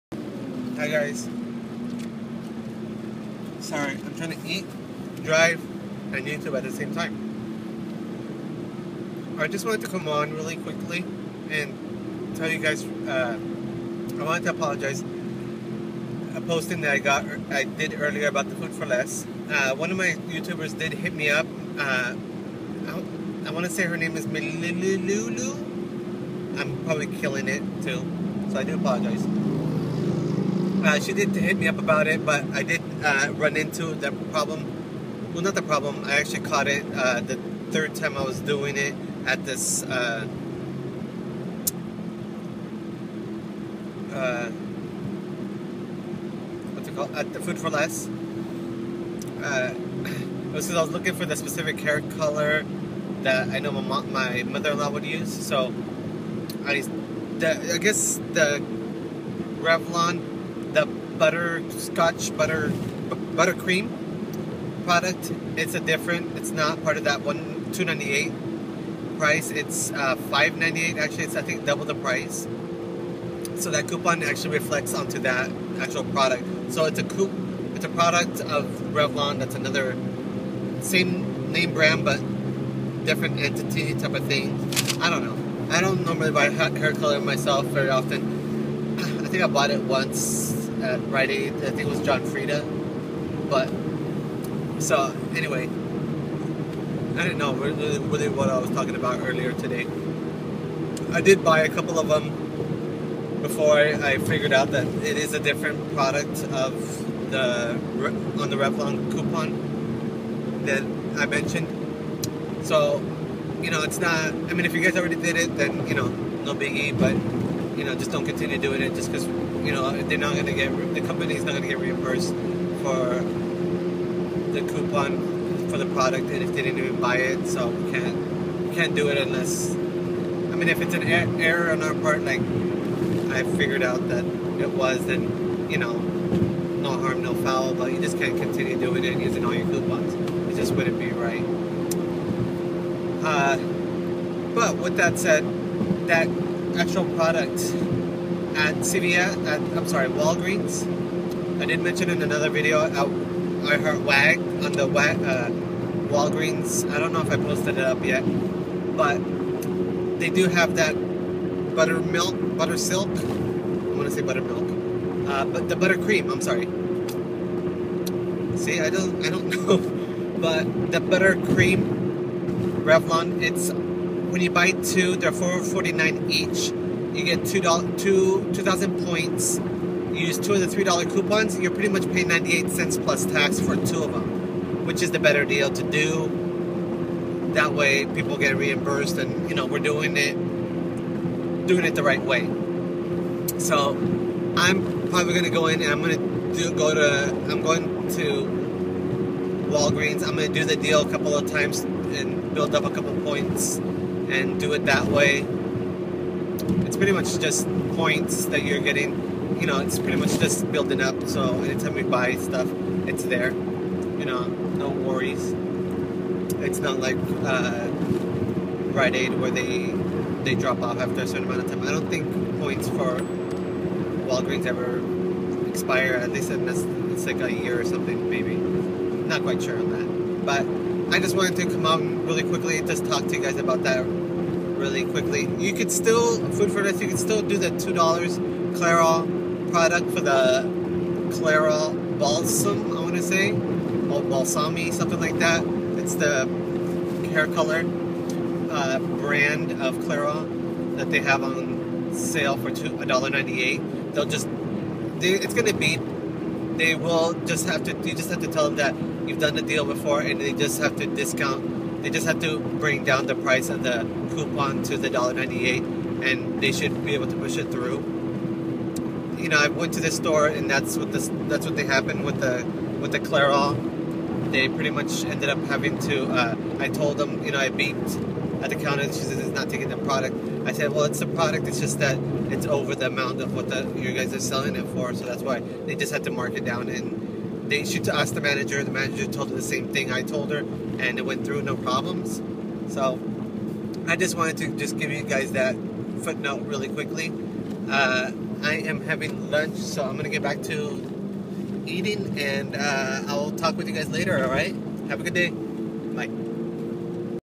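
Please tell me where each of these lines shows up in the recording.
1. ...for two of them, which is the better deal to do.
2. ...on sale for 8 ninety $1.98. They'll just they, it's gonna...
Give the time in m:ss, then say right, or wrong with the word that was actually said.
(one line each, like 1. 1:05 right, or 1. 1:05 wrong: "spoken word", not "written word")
1. 3:03 right
2. 4:11 wrong: "2", not "8".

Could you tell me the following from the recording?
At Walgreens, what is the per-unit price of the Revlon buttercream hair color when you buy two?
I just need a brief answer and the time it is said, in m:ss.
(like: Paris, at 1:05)
$4.49, at 2:55.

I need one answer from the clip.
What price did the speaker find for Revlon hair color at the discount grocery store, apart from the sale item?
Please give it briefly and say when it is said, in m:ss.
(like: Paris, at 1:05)
$5.98, at 1:10.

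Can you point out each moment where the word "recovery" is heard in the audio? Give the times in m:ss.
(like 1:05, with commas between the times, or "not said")
not said.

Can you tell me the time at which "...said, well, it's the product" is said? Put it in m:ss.
4:40.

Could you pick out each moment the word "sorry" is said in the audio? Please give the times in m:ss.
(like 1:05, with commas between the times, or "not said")
0:03, 2:29, 2:46.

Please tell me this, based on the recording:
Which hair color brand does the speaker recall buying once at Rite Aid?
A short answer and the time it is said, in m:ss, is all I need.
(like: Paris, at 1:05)
John Frieda, at 1:32.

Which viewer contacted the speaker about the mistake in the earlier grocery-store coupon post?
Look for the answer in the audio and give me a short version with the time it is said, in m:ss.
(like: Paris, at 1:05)
Melulu, at 0:24.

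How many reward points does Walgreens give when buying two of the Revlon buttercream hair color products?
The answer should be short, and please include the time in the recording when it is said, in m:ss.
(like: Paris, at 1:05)
2,000, at 2:58.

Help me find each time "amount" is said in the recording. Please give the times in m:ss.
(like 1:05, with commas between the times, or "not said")
3:41, 4:43.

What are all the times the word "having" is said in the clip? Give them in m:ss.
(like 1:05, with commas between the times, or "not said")
4:35, 4:59.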